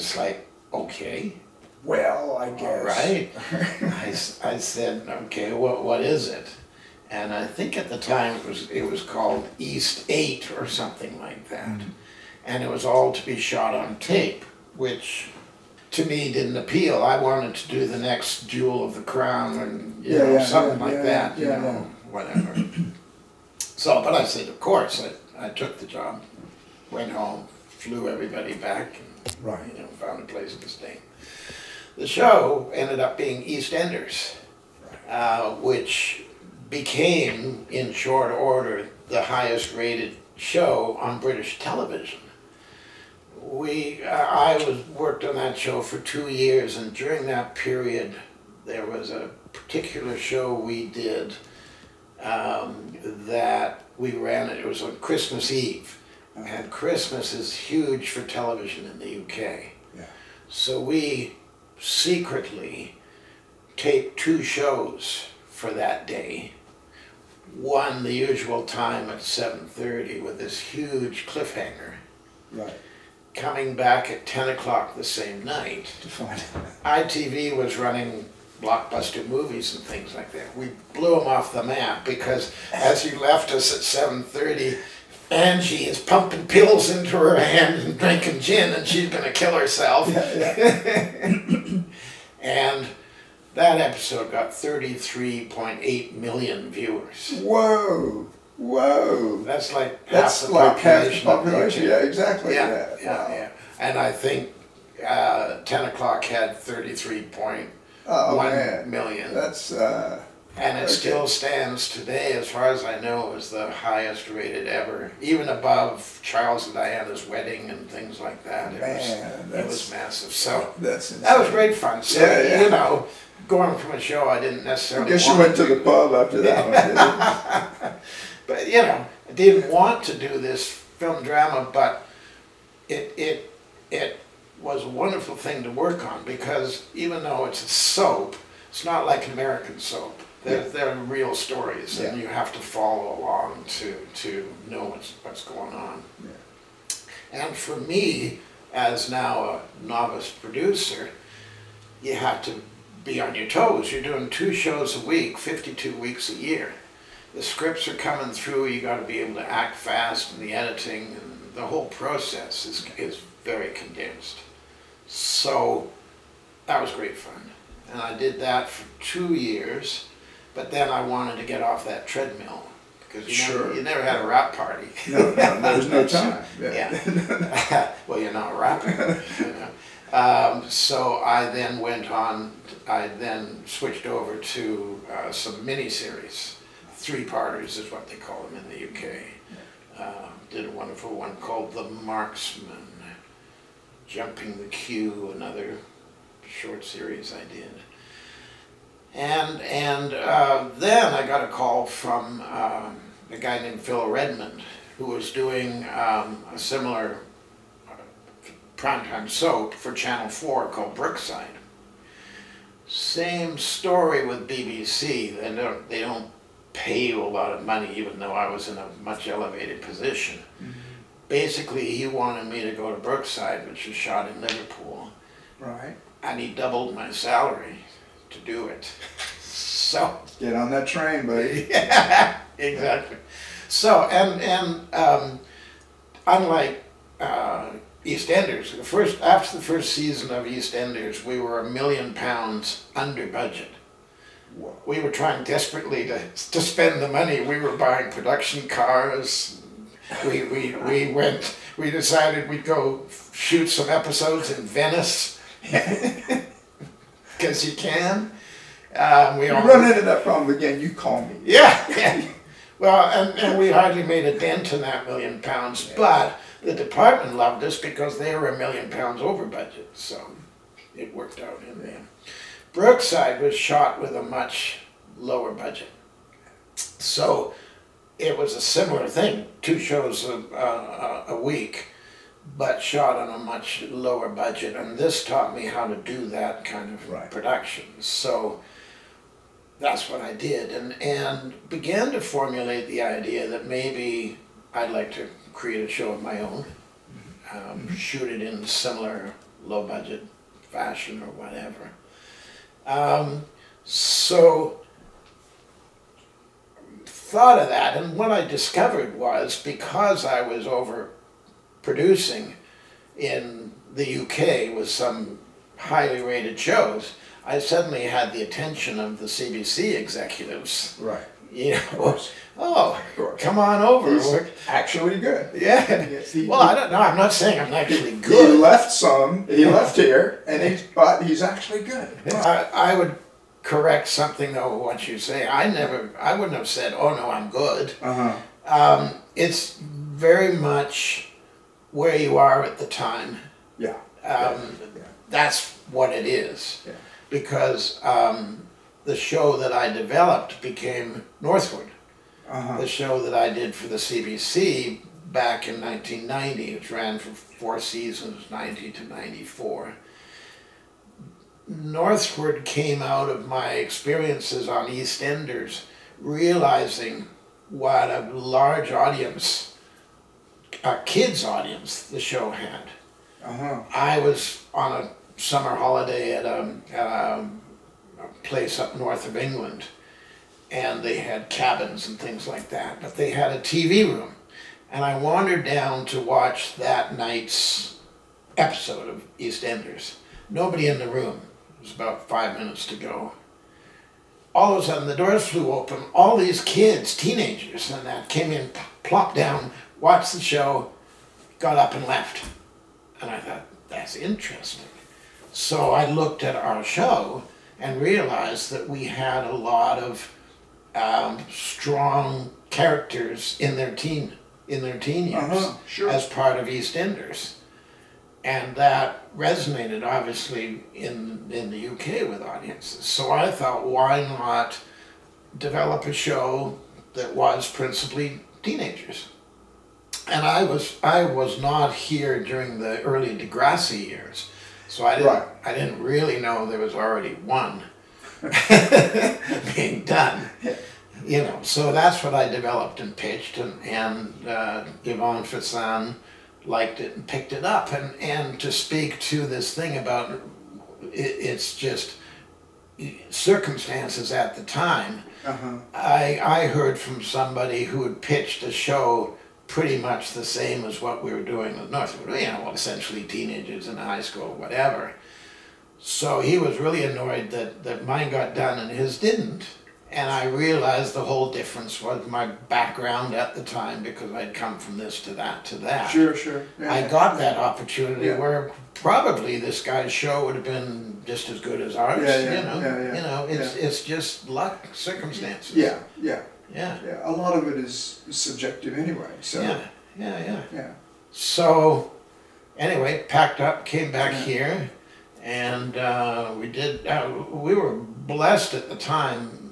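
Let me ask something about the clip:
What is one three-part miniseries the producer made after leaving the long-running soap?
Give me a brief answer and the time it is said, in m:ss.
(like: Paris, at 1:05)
The Marksman, at 3:11.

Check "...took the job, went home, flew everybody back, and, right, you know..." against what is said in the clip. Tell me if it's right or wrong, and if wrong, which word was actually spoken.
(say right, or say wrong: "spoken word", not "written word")
right.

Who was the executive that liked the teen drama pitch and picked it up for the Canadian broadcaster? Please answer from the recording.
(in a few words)
Ivan Fecan.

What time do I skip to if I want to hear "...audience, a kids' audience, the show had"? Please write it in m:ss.
6:08.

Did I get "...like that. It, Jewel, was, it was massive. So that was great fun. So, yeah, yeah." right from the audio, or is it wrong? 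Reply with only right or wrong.
wrong.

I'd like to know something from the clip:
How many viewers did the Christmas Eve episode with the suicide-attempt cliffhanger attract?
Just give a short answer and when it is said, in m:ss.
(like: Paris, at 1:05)
33.8 million, at 1:34.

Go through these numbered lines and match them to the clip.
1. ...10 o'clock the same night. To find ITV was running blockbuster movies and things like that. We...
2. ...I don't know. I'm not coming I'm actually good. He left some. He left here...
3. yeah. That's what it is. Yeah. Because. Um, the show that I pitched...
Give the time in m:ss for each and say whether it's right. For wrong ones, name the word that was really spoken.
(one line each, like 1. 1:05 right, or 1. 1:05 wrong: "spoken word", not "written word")
1. 1:14 right
2. 5:26 wrong: "saying", not "coming"
3. 5:44 wrong: "developed", not "pitched".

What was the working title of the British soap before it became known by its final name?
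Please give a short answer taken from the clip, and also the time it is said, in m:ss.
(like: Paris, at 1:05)
East Eight, at 0:09.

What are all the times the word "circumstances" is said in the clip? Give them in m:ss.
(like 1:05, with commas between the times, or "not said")
7:33, 8:04.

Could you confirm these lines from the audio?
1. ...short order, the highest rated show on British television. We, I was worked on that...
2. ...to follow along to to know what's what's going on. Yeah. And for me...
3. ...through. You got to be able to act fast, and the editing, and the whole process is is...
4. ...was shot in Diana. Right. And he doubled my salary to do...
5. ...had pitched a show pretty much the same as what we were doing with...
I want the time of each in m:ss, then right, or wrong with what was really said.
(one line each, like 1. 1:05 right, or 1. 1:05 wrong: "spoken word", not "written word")
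1. 0:37 right
2. 2:22 right
3. 2:38 right
4. 3:43 wrong: "Liverpool", not "Diana"
5. 7:38 right.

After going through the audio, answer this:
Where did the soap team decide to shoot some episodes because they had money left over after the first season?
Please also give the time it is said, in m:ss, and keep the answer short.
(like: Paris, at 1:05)
Venice, at 4:14.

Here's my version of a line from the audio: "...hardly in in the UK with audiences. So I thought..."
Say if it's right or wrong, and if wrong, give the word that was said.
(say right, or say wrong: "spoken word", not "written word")
wrong: "obviously", not "hardly".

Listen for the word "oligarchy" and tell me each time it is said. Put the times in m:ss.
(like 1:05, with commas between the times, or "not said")
not said.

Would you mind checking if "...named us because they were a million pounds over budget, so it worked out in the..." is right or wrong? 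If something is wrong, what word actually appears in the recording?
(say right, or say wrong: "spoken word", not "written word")
wrong: "loved", not "named".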